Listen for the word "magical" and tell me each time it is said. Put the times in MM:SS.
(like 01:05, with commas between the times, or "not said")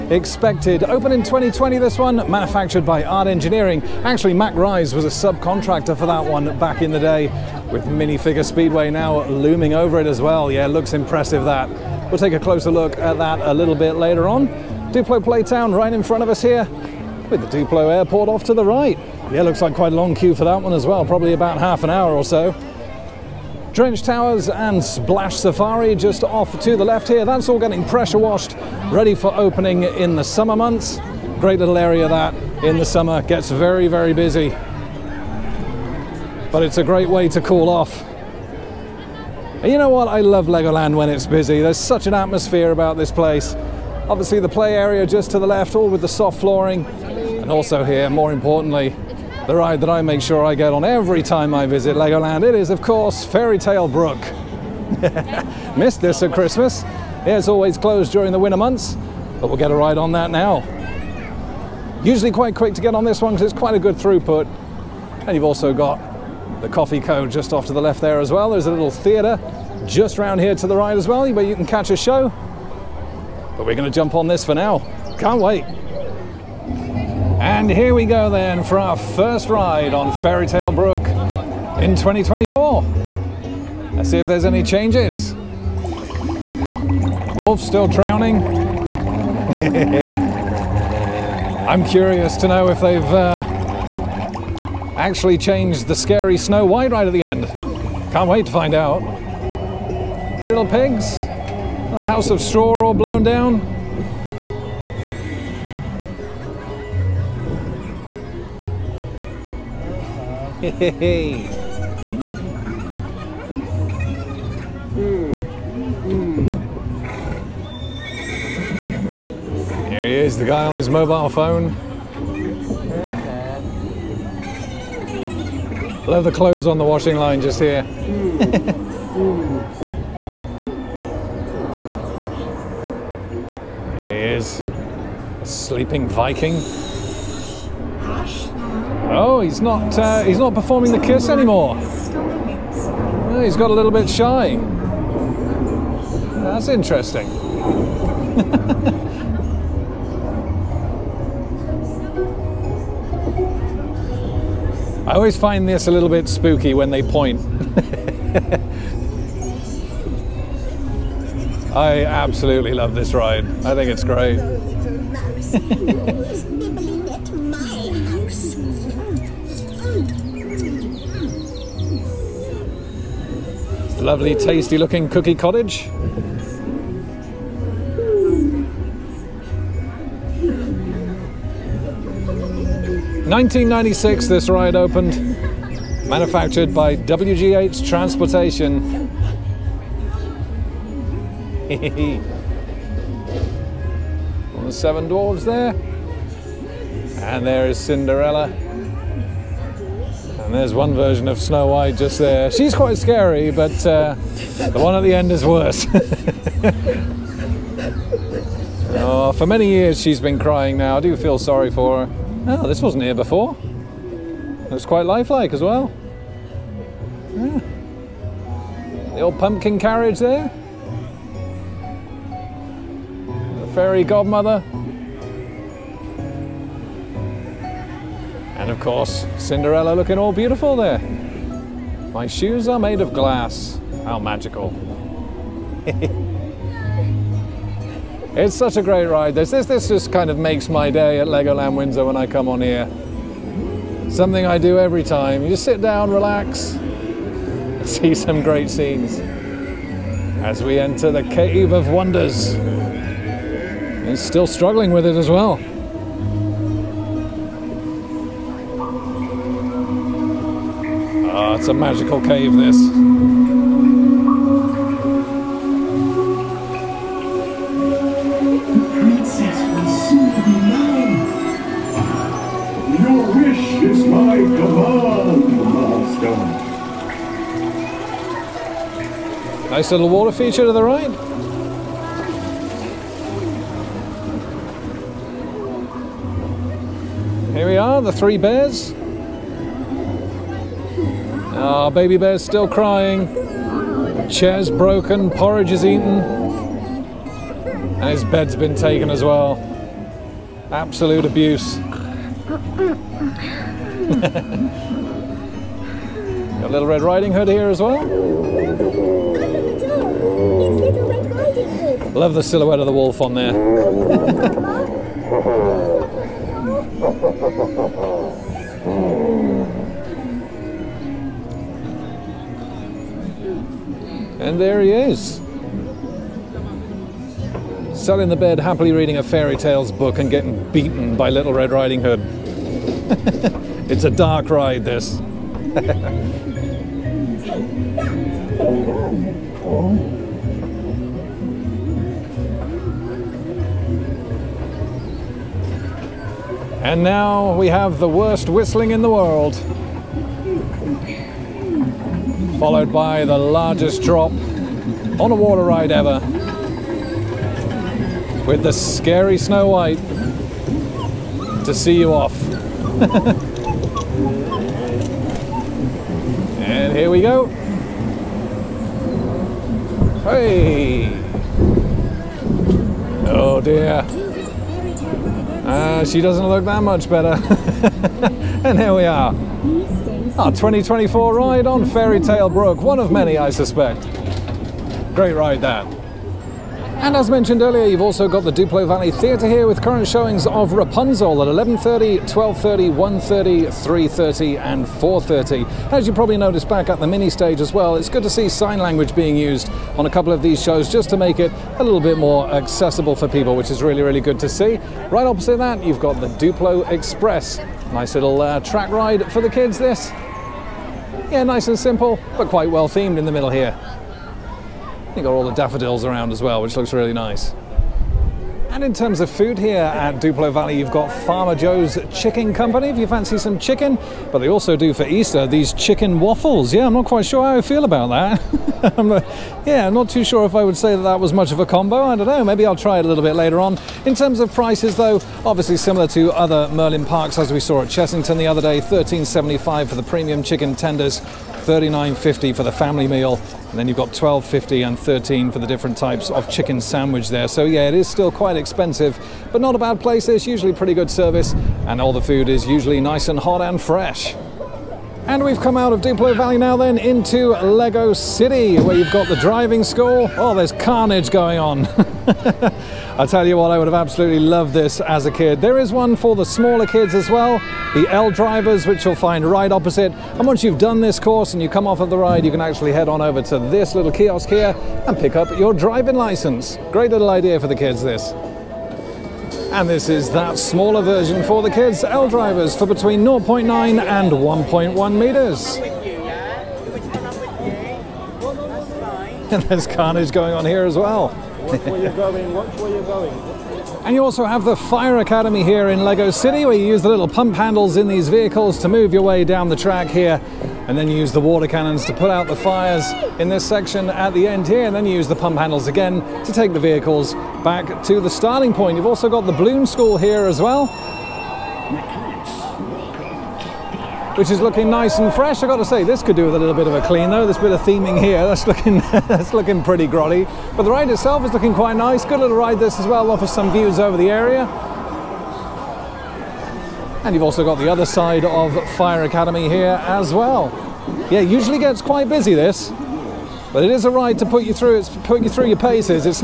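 03:54, 04:21.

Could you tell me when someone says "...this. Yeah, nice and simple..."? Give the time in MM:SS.
06:49.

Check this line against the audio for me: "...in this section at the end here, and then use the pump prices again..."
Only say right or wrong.
wrong.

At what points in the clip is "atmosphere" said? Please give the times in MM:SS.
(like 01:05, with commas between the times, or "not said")
00:42.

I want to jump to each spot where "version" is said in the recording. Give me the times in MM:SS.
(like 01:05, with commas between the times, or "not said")
03:20, 08:01.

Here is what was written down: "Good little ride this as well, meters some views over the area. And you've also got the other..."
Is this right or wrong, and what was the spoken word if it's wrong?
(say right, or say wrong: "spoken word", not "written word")
wrong: "offers", not "meters".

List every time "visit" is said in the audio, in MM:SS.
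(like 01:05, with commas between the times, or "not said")
00:51.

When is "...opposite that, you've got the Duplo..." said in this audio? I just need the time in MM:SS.
06:45.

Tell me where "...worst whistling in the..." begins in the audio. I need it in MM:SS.
05:48.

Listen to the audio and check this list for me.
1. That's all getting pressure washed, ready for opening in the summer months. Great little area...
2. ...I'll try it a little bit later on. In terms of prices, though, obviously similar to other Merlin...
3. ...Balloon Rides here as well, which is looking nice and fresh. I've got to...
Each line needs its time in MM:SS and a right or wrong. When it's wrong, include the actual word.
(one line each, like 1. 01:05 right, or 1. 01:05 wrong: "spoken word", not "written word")
1. 00:27 right
2. 07:12 right
3. 08:29 wrong: "School", not "Rides".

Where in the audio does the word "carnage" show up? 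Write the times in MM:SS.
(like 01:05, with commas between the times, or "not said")
07:40, 08:09.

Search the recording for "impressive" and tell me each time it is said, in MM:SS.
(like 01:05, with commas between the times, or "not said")
00:10.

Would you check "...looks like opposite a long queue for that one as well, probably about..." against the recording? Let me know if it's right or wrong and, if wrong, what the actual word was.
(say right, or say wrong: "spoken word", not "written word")
wrong: "quite", not "opposite".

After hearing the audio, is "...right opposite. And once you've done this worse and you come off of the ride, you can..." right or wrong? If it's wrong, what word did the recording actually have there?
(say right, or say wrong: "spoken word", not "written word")
wrong: "course", not "worse".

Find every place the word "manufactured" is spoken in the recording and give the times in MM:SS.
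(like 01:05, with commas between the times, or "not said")
00:02, 03:06.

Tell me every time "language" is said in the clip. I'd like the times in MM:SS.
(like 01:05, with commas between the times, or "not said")
06:38.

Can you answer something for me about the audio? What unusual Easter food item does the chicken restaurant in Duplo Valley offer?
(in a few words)
chicken waffles.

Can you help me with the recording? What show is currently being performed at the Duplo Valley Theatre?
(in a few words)
Rapunzel.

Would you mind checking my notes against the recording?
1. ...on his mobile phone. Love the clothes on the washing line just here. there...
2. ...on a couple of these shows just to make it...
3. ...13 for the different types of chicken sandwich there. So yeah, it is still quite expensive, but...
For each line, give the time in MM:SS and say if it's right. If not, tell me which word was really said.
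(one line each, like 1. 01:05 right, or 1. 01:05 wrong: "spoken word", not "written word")
1. 02:00 right
2. 06:39 right
3. 07:24 right.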